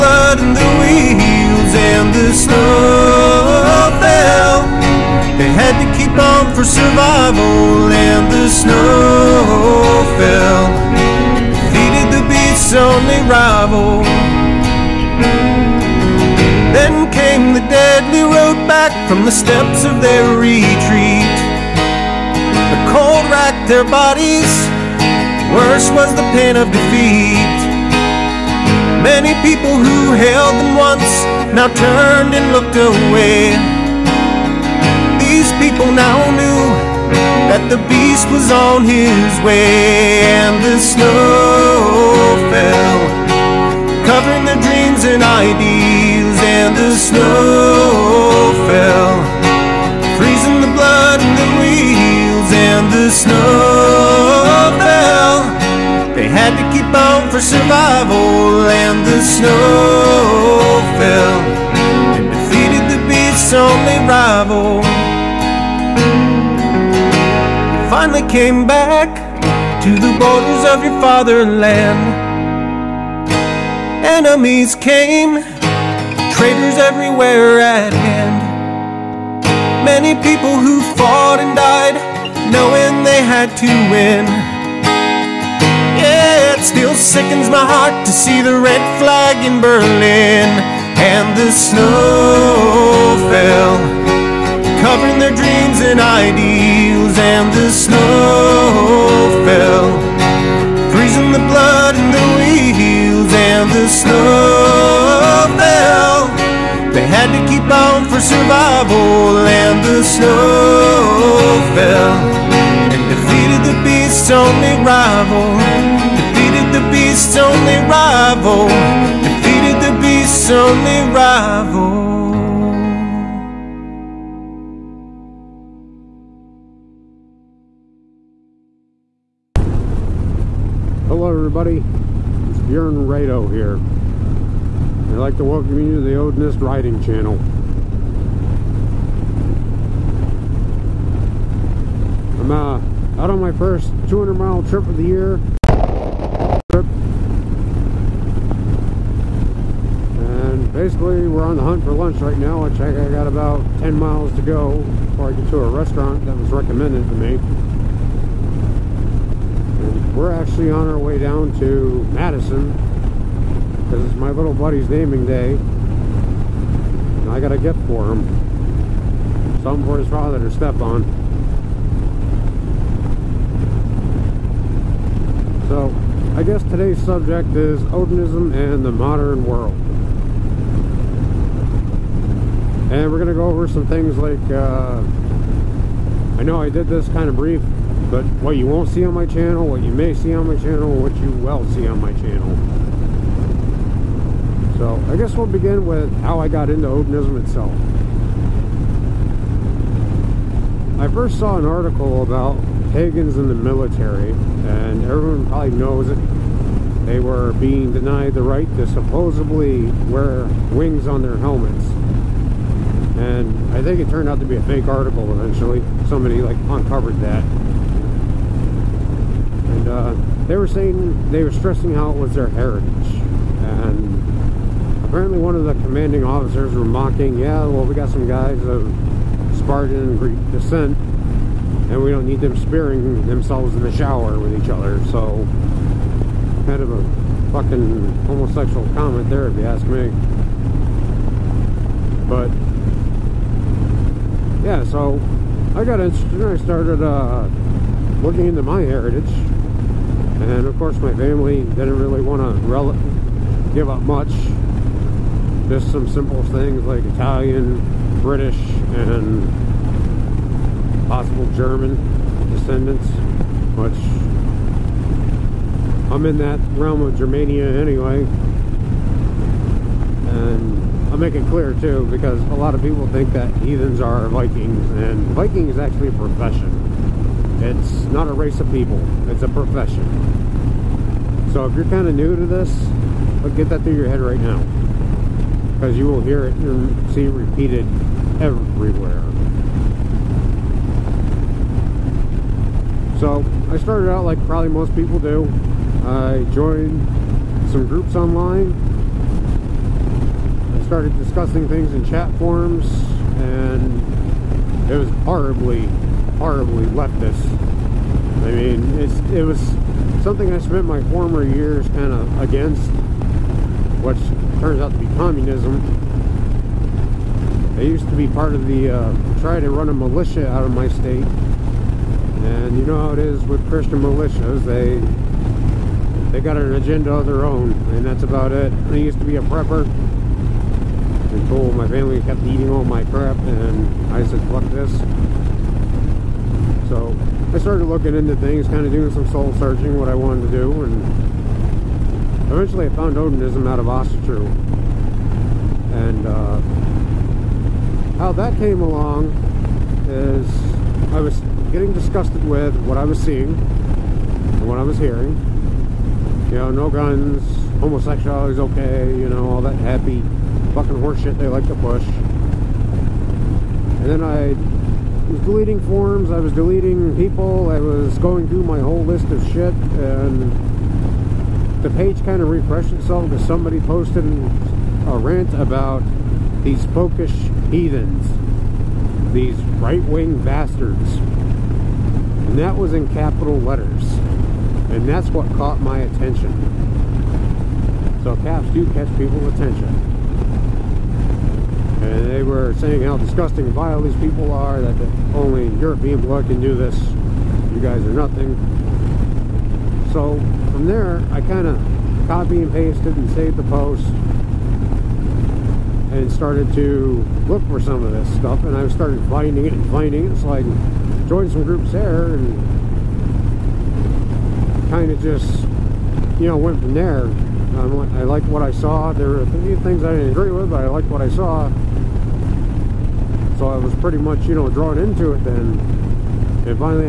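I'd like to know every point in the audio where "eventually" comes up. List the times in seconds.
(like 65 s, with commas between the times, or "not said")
215 s, 342 s.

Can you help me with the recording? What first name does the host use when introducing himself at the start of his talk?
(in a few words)
Bjorn.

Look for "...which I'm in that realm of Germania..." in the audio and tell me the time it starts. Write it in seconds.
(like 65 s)
263 s.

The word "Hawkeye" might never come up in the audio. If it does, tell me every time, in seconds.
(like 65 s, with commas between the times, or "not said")
not said.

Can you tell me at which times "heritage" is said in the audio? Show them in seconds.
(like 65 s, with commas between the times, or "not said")
222 s, 248 s.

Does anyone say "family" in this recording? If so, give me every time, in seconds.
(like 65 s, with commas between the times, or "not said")
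251 s, 331 s.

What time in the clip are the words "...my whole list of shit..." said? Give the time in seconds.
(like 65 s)
368 s.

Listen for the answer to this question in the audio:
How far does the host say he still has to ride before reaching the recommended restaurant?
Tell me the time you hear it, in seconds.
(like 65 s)
153 s.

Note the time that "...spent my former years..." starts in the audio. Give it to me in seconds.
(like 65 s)
310 s.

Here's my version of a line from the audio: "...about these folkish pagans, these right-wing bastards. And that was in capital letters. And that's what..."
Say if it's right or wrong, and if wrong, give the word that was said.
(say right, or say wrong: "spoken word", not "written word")
wrong: "heathens", not "pagans".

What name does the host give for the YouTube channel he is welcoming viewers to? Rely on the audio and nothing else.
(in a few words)
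Odinist Riding Channel.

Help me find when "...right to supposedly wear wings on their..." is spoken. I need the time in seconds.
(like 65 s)
208 s.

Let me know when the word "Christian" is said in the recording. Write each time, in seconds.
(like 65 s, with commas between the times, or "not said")
323 s.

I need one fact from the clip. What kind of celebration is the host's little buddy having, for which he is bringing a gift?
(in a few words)
Naming day.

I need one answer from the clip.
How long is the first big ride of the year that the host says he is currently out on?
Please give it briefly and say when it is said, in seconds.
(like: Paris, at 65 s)
200 miles, at 144 s.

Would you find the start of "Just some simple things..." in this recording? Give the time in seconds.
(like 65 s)
255 s.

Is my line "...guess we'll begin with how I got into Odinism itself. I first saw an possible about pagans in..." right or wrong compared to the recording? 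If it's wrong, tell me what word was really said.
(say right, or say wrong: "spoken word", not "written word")
wrong: "article", not "possible".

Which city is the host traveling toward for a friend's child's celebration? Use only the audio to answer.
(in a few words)
Madison.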